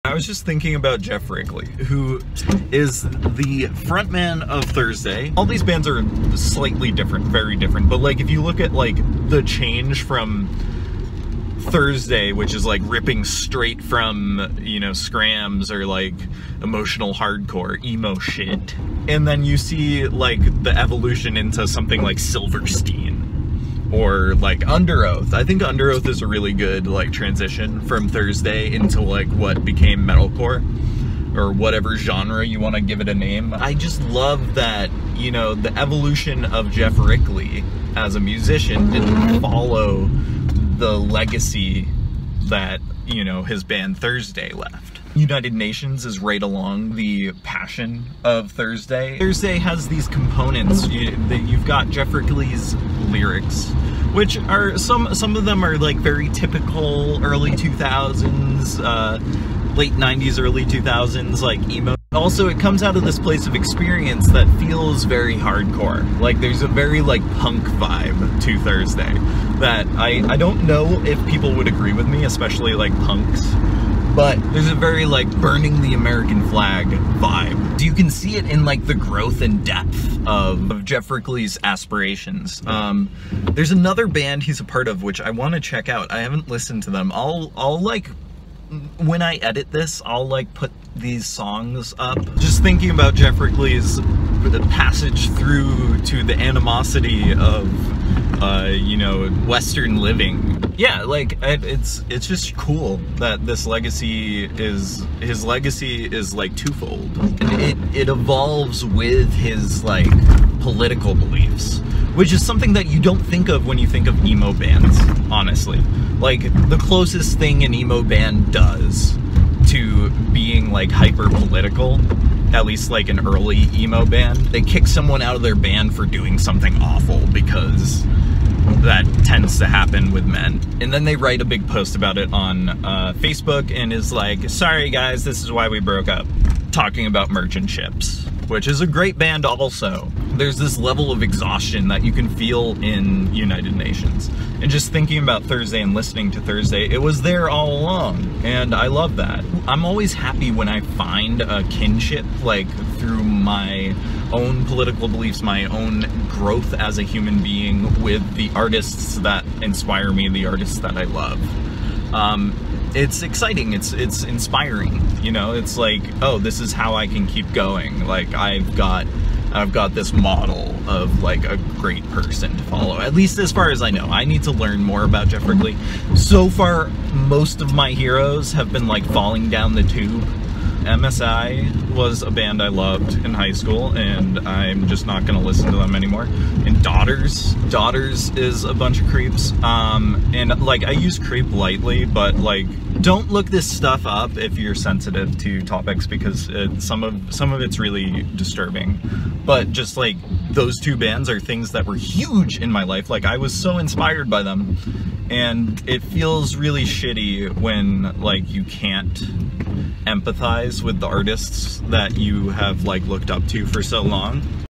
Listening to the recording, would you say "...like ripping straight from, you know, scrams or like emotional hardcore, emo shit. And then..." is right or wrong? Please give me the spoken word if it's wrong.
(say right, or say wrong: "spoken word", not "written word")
right.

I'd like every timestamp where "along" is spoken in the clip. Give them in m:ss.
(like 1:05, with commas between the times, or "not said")
0:46, 2:27.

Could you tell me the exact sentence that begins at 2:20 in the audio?
There's this level of exhaustion that you can feel in United Nations.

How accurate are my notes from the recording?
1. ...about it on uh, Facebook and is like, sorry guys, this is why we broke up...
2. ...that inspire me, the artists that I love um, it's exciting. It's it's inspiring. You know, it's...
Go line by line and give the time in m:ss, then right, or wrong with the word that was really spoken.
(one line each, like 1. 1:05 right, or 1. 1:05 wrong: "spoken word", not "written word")
1. 2:11 right
2. 2:39 right.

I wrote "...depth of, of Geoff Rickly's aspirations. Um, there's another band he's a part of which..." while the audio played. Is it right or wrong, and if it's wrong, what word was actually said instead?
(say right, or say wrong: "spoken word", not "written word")
right.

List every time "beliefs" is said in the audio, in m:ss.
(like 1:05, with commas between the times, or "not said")
1:51, 2:35.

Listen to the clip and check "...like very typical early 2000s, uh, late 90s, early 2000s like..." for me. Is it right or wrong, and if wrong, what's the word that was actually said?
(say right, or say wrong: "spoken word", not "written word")
right.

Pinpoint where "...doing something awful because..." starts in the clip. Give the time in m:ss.
2:06.